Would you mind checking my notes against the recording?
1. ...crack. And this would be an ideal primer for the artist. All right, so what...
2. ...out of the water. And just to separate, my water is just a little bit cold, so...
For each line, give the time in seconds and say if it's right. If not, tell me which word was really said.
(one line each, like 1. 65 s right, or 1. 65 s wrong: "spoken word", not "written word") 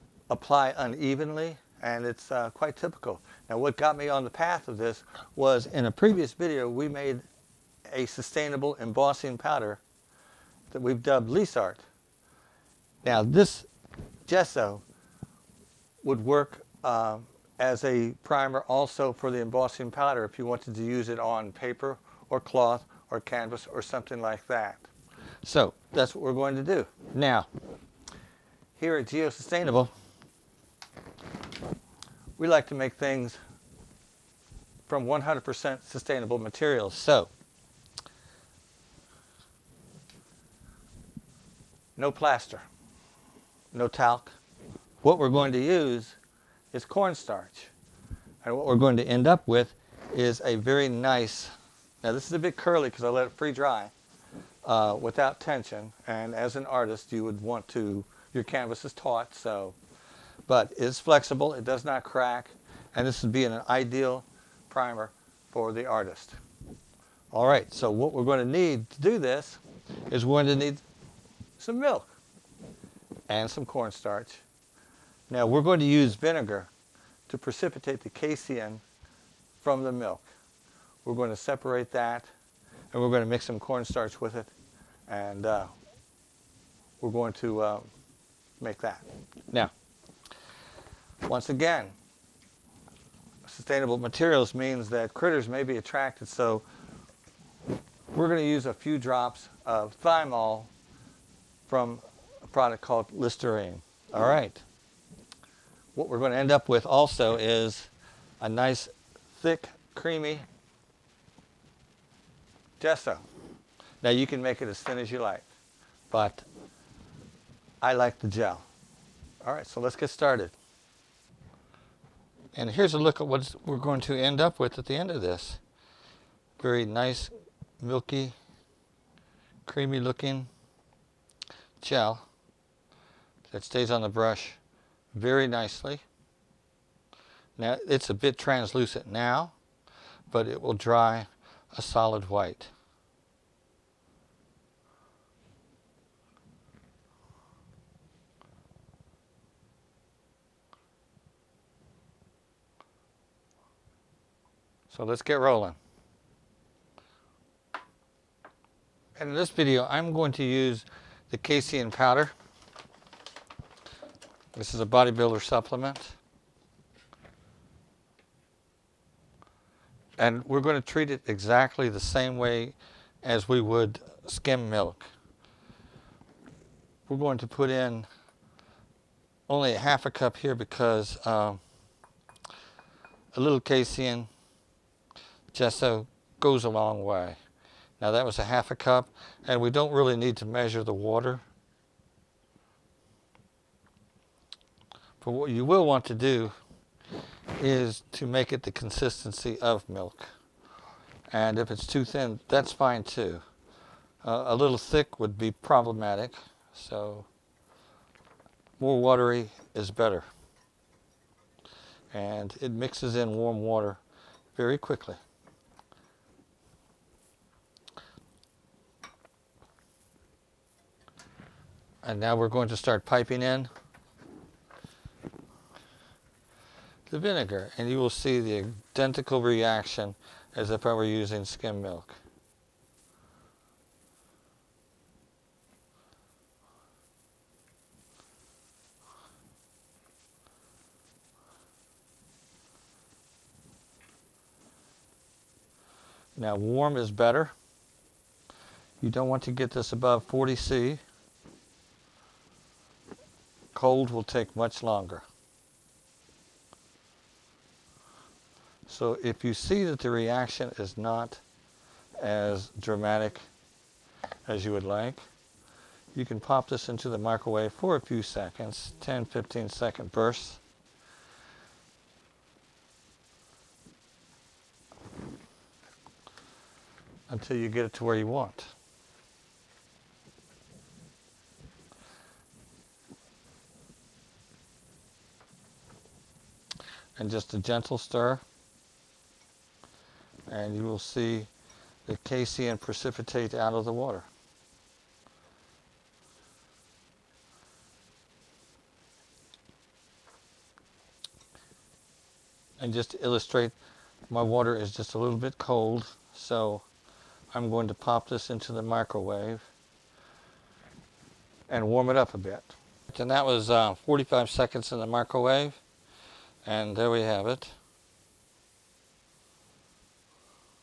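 1. 62 s right
2. 293 s wrong: "illustrate", not "separate".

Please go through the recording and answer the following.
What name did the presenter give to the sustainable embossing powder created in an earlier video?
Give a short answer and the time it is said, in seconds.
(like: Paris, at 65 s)
Lease Art, at 11 s.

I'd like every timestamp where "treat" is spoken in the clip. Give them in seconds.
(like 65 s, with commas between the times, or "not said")
170 s.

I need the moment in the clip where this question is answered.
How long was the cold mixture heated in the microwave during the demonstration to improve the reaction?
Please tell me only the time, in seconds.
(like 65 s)
313 s.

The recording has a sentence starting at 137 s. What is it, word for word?
Now it's a bit translucent now, but it will dry a solid white.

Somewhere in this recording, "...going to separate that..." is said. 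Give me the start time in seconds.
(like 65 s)
81 s.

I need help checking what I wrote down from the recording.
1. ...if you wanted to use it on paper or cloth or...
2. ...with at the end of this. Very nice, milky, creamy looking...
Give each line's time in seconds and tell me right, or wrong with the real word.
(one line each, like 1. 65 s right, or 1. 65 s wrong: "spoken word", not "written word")
1. 20 s right
2. 124 s right.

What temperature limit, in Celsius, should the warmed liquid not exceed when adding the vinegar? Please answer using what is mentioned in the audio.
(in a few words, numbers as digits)
40 C.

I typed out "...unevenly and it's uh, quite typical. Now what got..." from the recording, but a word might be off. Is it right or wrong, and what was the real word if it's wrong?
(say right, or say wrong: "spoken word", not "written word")
right.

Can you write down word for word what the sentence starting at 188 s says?
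Now that was a half a cup, and we don't really need to measure the water.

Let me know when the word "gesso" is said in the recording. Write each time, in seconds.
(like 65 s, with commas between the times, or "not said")
14 s, 112 s.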